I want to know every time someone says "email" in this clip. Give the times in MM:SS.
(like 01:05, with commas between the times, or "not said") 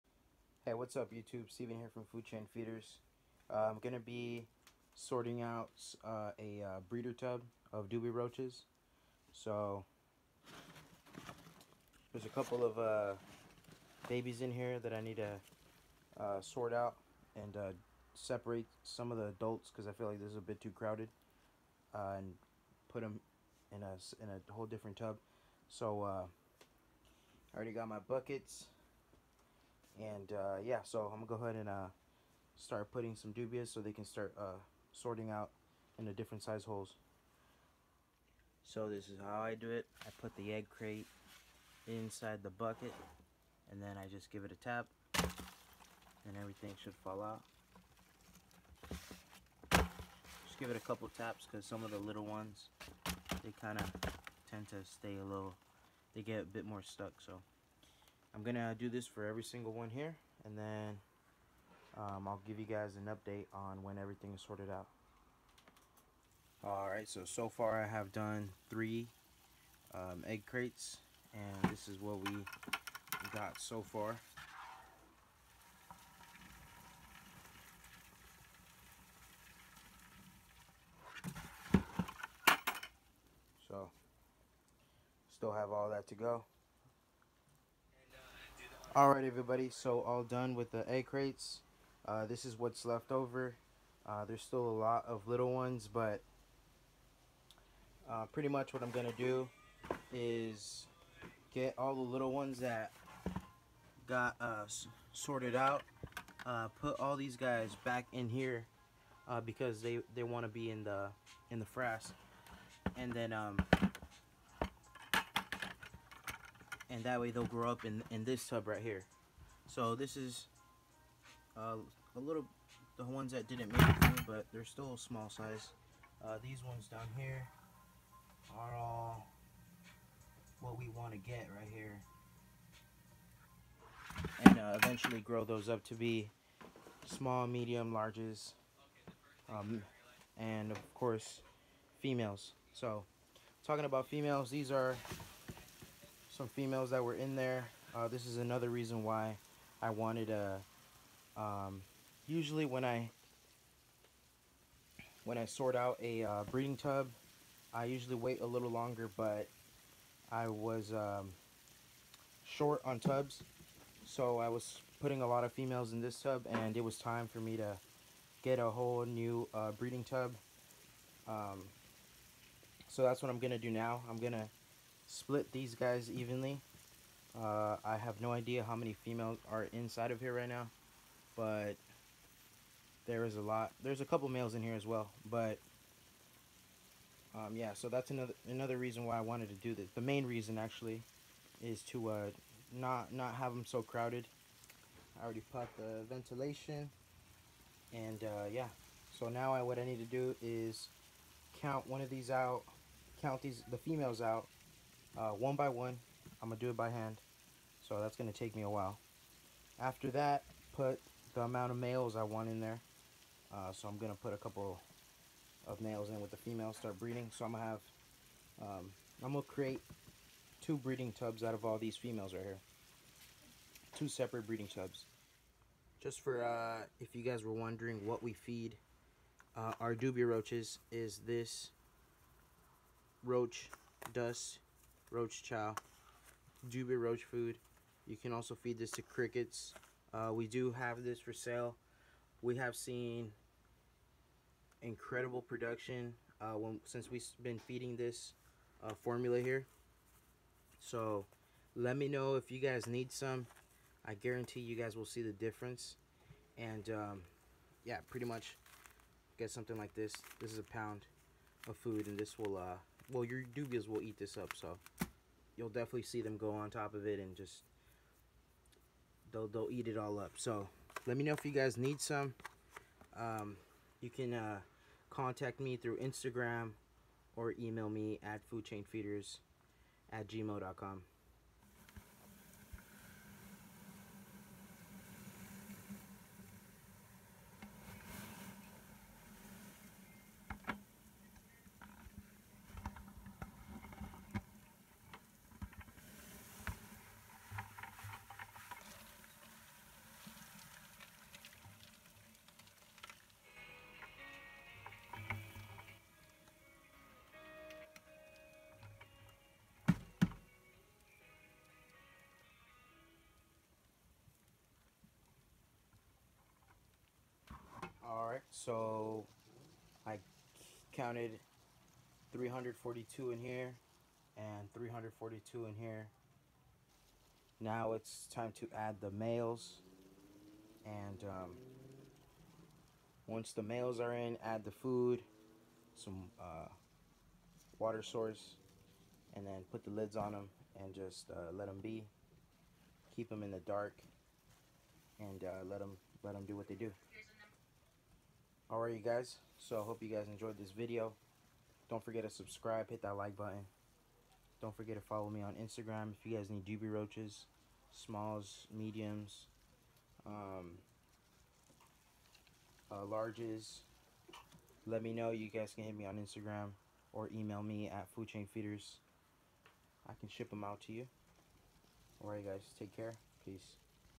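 04:37, 06:07.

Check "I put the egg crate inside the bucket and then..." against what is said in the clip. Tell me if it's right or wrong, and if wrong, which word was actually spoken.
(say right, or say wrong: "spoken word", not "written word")
right.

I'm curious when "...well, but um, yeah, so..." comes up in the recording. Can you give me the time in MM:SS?
03:04.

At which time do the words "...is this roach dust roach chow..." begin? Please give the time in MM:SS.
03:50.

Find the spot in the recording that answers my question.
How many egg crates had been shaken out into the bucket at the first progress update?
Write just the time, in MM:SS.
01:08.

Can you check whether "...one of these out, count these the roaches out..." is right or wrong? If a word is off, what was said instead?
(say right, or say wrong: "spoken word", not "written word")
wrong: "females", not "roaches".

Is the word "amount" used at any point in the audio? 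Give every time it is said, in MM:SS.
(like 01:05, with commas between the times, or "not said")
03:31.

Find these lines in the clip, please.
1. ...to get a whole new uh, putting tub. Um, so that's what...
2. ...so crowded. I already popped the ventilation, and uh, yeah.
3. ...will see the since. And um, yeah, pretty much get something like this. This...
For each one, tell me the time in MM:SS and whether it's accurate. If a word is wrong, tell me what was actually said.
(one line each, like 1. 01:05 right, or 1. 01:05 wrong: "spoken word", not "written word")
1. 02:47 wrong: "breeding", not "putting"
2. 03:13 right
3. 04:14 wrong: "difference", not "since".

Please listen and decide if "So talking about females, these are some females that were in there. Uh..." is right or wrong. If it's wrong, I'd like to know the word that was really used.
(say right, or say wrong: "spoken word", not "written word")
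right.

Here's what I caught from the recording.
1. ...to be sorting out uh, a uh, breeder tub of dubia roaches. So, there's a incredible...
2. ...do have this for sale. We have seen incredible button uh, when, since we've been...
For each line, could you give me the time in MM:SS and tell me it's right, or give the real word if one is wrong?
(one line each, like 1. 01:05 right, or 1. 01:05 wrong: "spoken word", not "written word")
1. 00:03 wrong: "couple", not "incredible"
2. 04:00 wrong: "production", not "button".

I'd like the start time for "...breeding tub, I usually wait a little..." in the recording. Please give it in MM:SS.
02:36.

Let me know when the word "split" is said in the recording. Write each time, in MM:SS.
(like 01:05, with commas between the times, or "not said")
02:55.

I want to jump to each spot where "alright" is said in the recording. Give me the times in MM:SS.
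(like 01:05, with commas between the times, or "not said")
01:06, 01:28, 05:18, 05:48, 06:12.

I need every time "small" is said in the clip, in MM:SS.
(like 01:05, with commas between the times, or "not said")
02:04, 02:17, 05:57.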